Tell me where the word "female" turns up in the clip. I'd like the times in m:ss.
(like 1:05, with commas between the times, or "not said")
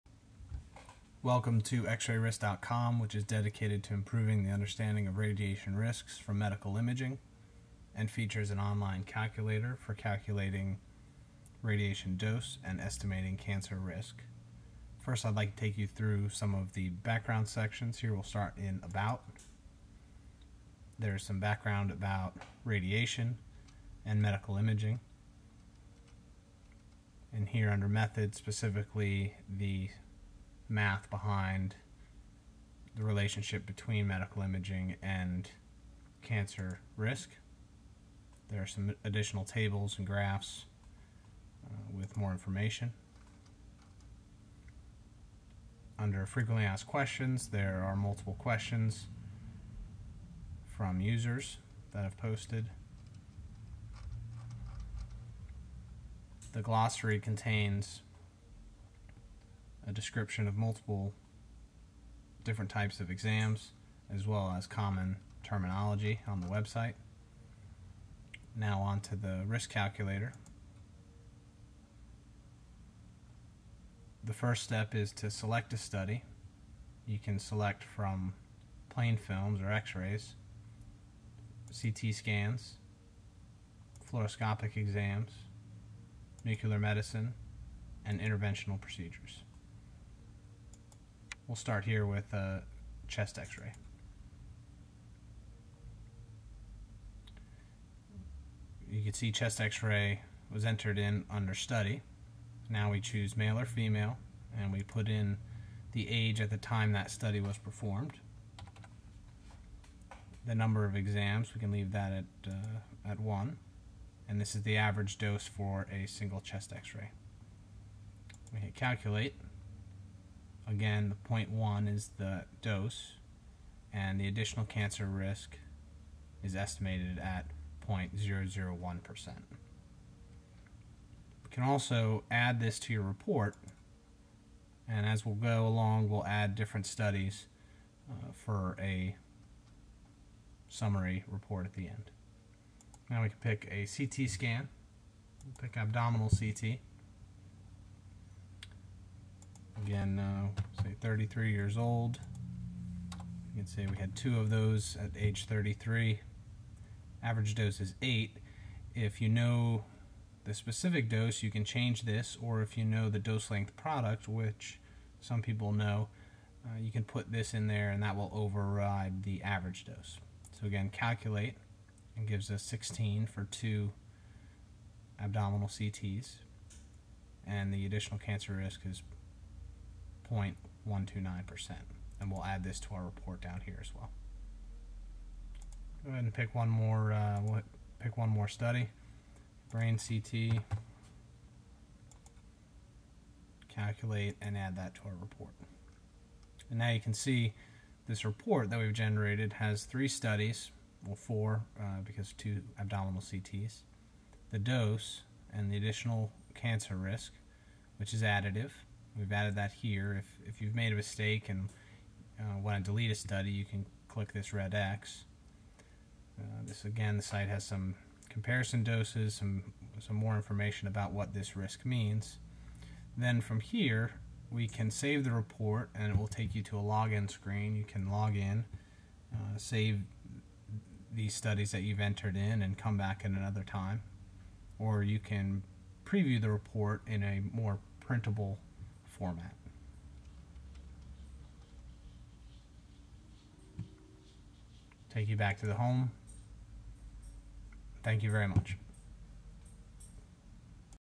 1:43.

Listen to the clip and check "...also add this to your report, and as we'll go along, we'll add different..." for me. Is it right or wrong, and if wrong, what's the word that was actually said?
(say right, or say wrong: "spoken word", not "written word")
right.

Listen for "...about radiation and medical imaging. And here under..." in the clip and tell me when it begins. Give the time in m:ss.
0:21.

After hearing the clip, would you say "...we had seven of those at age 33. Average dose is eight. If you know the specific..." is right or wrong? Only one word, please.
wrong.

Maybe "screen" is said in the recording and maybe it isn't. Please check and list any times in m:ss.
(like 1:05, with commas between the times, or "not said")
3:47.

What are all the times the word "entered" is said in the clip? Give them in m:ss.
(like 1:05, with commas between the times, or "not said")
1:40, 3:51.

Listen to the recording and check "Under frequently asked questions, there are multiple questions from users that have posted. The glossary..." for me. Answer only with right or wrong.
right.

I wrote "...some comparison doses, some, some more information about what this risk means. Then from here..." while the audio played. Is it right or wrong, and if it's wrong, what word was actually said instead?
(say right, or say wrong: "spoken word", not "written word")
right.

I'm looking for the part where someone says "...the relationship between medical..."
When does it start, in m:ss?
0:32.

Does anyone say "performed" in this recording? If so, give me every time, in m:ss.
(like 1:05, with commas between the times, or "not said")
1:47.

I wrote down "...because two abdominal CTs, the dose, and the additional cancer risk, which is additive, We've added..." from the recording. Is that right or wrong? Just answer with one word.
right.